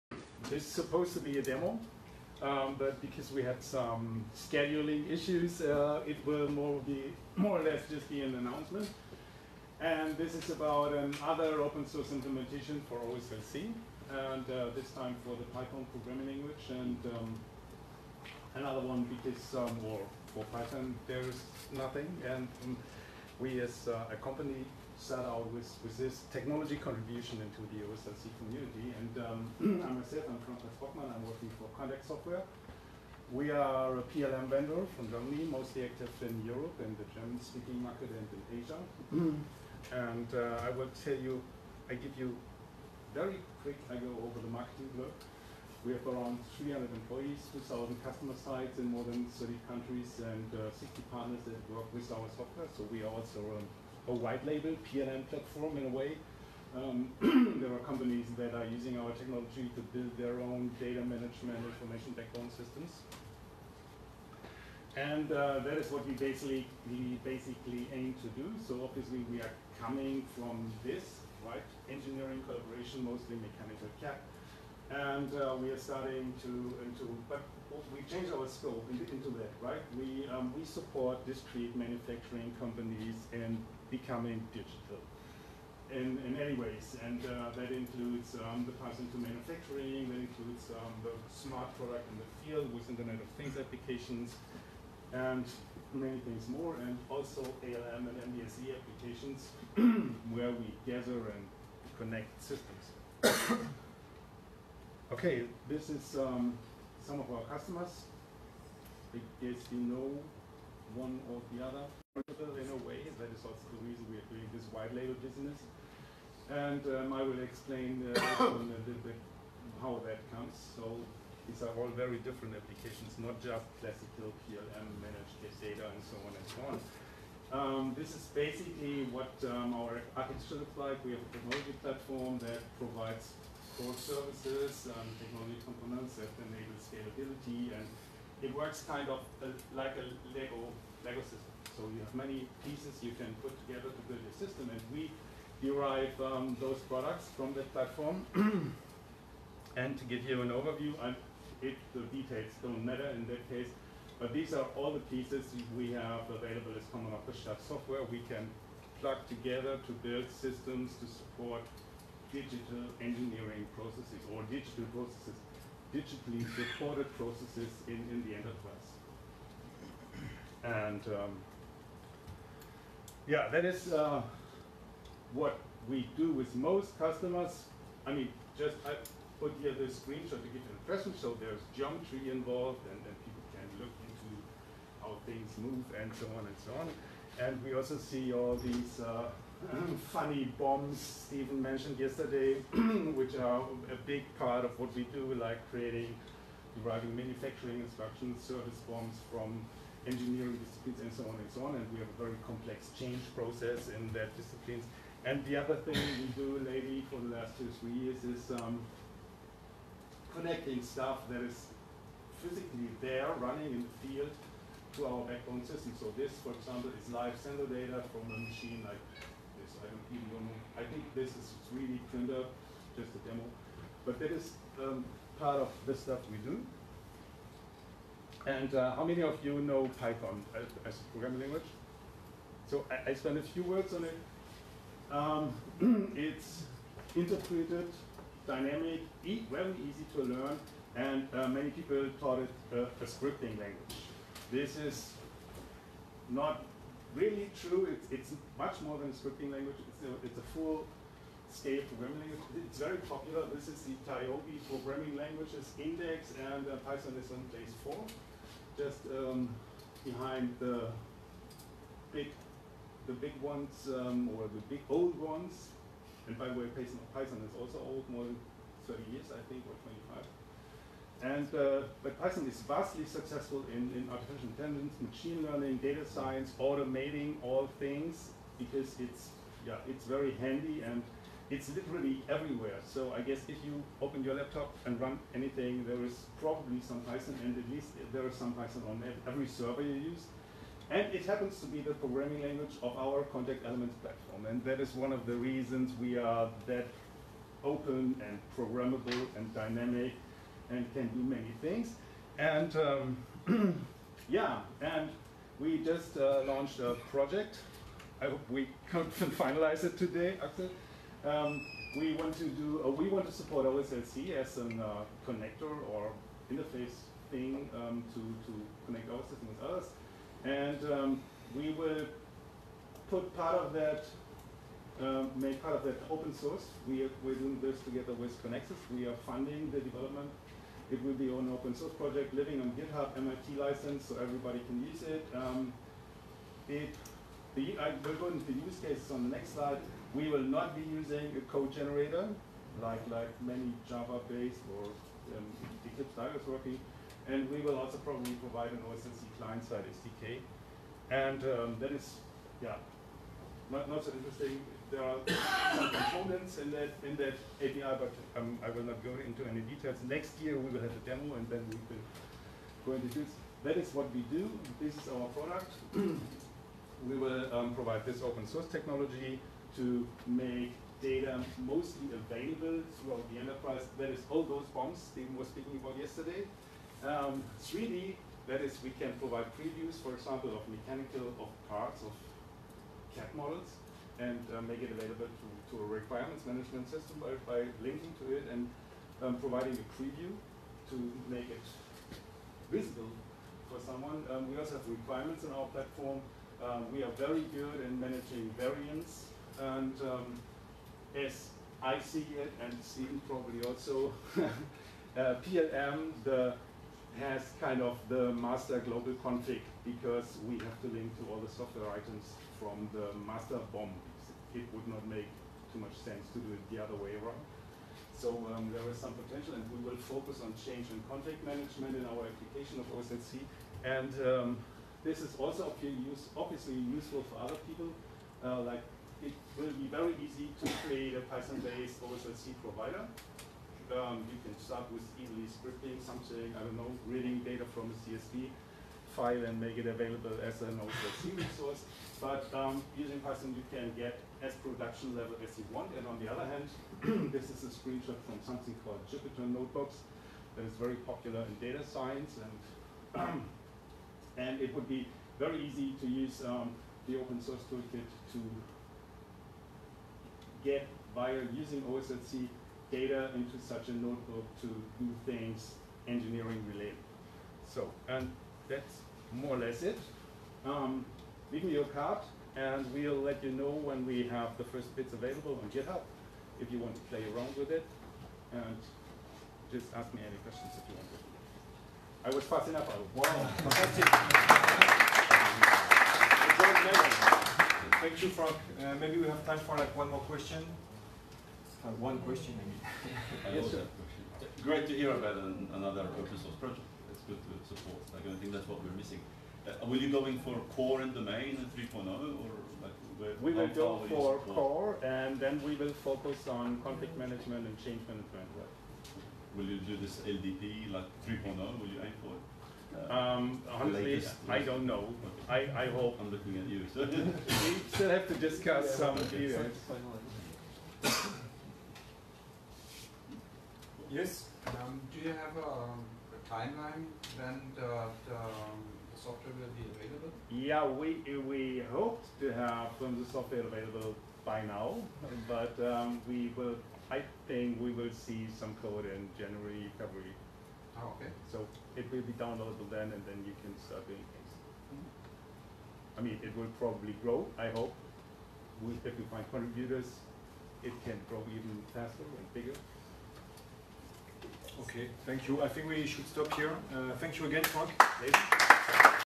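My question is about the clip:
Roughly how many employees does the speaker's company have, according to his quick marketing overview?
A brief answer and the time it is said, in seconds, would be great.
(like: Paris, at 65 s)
300, at 46 s.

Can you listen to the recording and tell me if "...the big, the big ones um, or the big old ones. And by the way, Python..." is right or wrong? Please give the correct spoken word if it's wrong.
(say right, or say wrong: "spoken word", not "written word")
right.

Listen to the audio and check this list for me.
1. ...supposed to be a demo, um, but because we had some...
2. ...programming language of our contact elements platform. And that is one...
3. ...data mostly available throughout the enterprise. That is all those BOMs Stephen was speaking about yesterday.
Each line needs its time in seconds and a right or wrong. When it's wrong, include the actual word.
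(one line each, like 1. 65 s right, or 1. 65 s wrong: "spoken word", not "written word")
1. 0 s right
2. 291 s right
3. 371 s right.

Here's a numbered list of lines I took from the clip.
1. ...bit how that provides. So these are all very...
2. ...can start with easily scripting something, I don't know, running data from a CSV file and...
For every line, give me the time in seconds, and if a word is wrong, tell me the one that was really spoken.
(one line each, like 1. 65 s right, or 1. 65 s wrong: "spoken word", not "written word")
1. 119 s wrong: "comes", not "provides"
2. 434 s wrong: "reading", not "running".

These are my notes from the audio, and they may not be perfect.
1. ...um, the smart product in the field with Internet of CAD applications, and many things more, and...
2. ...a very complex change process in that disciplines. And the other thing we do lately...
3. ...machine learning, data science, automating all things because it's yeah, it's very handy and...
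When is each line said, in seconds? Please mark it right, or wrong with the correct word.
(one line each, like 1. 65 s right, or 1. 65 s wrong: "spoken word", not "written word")
1. 90 s wrong: "Things", not "CAD"
2. 202 s right
3. 274 s right.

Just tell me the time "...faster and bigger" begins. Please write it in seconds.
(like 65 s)
551 s.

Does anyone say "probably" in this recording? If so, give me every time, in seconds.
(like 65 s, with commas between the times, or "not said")
286 s, 347 s, 403 s, 546 s.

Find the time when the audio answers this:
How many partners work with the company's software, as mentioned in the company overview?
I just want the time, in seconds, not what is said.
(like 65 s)
50 s.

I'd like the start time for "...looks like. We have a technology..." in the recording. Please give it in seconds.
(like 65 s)
130 s.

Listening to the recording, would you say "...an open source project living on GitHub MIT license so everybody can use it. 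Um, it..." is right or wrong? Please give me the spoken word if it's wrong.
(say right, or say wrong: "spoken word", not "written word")
right.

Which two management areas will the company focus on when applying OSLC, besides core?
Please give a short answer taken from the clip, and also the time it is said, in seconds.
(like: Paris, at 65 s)
change and config management, at 420 s.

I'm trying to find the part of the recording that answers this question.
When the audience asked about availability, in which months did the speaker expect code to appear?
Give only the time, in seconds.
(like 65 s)
539 s.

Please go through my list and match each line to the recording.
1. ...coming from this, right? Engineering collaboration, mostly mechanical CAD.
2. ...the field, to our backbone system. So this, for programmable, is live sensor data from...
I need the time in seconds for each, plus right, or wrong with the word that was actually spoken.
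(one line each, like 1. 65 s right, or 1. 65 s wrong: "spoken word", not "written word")
1. 69 s right
2. 213 s wrong: "example", not "programmable".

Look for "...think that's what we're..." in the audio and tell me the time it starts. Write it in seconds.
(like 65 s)
498 s.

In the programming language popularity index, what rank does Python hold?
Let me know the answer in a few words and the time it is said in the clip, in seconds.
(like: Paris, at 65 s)
4, at 257 s.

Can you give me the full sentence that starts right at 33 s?
We are a PLM vendor from Germany, mostly active in Europe and the German-speaking market and in Asia.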